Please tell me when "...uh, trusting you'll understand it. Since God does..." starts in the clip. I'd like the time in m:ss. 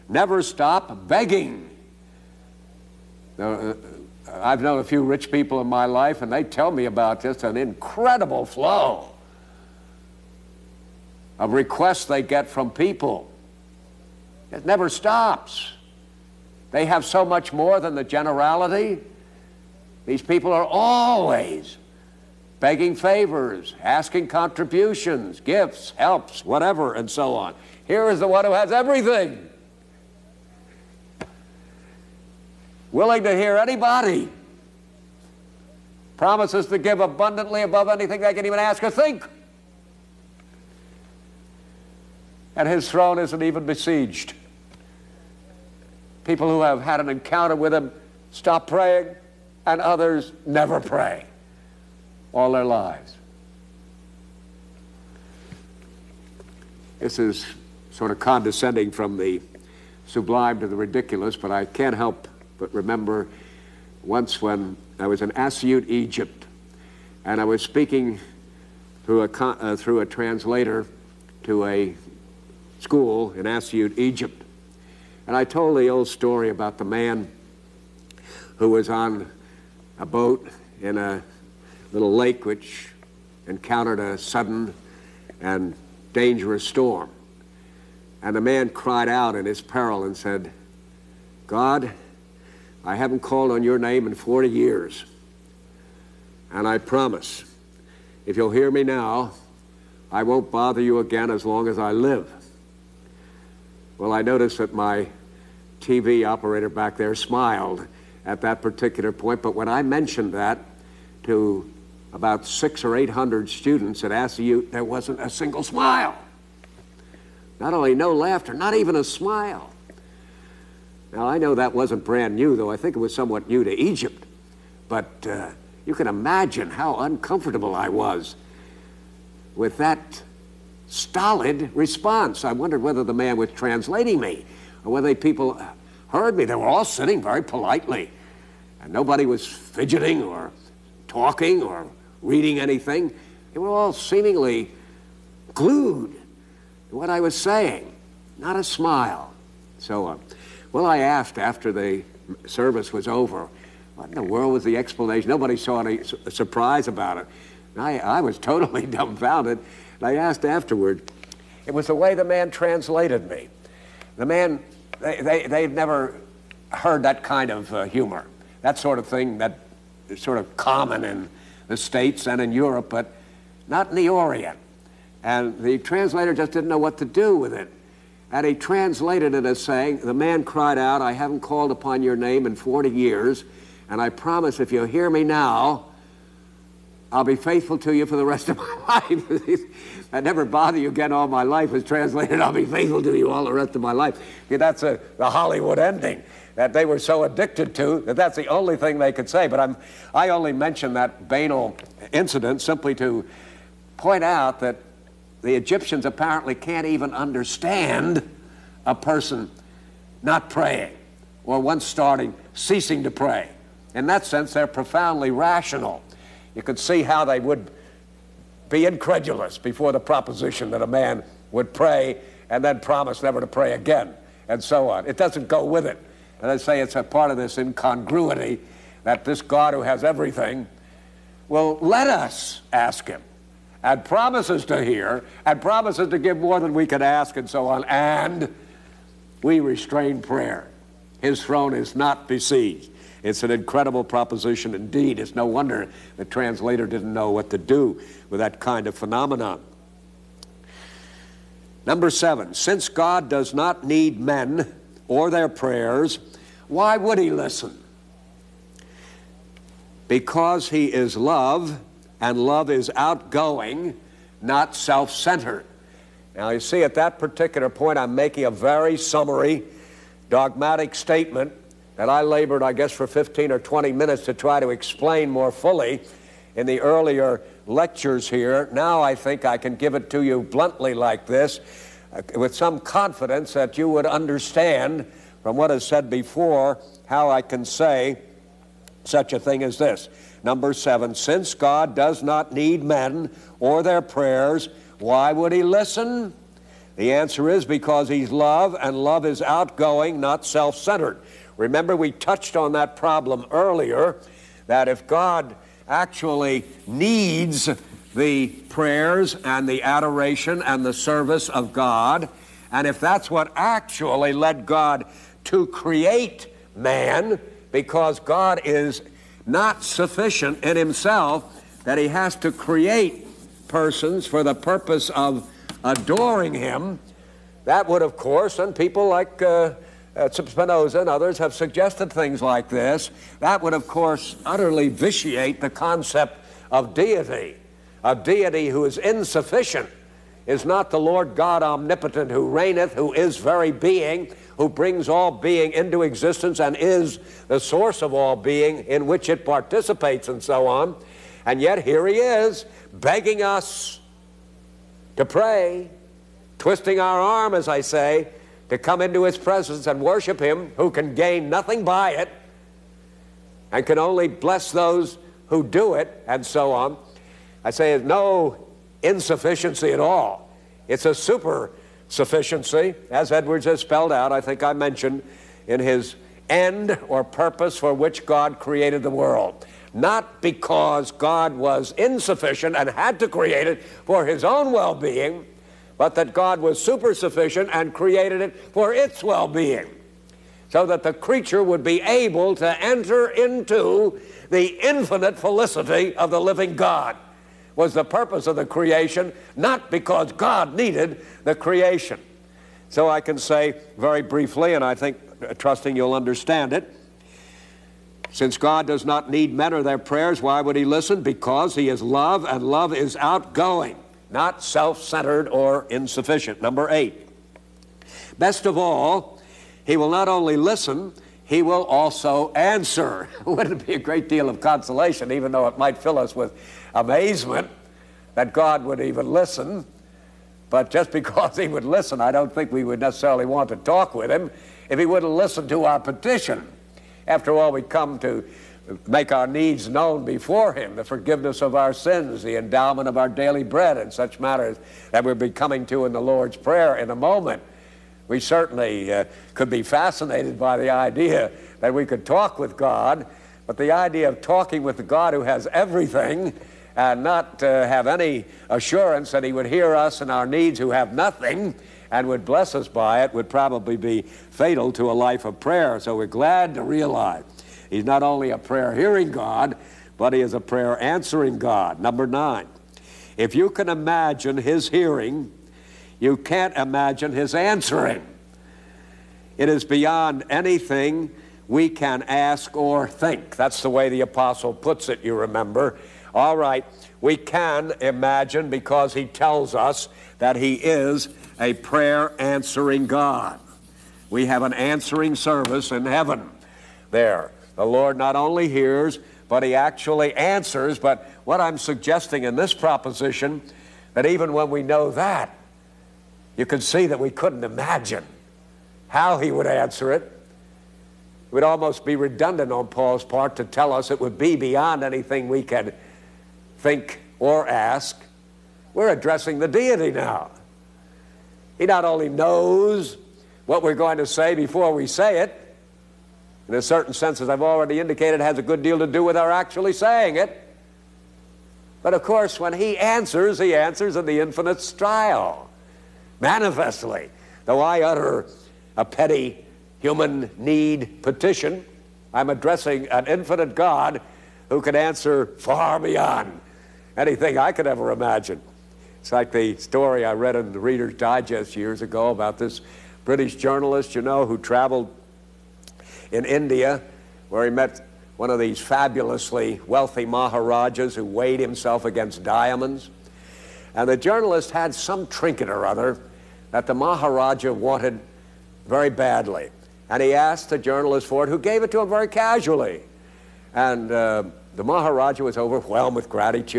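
6:45.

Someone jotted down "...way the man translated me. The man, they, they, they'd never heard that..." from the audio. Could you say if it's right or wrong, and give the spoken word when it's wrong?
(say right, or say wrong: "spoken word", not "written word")
right.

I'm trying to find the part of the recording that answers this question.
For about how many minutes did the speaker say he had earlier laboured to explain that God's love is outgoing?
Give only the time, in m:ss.
4:33.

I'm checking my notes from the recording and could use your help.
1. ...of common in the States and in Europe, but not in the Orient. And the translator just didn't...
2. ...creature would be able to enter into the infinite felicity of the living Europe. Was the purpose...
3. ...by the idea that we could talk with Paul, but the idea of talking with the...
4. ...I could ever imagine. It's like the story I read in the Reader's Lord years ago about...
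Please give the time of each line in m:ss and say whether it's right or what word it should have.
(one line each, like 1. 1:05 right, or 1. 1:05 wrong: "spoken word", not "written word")
1. 2:50 right
2. 6:31 wrong: "God", not "Europe"
3. 7:30 wrong: "God", not "Paul"
4. 9:07 wrong: "Digest", not "Lord".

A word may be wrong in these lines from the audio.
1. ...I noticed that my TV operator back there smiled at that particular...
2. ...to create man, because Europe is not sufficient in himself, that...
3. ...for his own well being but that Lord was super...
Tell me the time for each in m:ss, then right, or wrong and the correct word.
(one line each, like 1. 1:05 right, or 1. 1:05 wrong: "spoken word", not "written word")
1. 1:44 right
2. 5:15 wrong: "God", not "Europe"
3. 6:23 wrong: "God", not "Lord".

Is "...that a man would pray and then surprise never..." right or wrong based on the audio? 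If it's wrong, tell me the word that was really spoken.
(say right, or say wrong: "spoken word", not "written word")
wrong: "promise", not "surprise".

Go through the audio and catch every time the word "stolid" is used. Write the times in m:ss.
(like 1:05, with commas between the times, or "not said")
2:10.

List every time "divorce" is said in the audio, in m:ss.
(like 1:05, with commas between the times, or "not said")
not said.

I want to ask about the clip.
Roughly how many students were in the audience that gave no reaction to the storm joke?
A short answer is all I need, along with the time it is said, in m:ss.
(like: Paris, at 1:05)
600 to 800, at 1:52.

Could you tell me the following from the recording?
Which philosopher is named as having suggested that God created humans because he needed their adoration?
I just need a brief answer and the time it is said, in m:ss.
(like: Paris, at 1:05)
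Spinoza, at 5:30.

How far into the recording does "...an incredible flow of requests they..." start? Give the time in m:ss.
0:07.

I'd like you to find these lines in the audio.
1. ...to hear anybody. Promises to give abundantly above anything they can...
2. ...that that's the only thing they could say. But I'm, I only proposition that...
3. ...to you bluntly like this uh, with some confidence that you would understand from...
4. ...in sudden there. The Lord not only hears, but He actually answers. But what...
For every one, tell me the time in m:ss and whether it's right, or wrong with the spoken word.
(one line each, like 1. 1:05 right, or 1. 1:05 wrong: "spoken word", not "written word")
1. 0:33 right
2. 3:18 wrong: "mention", not "proposition"
3. 4:40 right
4. 8:15 wrong: "heaven", not "sudden".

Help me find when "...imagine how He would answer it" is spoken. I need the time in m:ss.
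8:27.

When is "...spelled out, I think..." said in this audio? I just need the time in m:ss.
6:13.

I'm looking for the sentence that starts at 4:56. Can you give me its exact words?
The answer is because he's love, and love is outgoing, not self centered.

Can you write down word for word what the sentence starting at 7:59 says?
It is beyond anything we can ask or think.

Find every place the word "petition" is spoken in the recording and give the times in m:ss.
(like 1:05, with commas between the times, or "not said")
7:16, 9:01.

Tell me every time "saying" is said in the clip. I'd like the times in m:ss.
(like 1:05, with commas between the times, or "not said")
2:27, 2:59, 8:49.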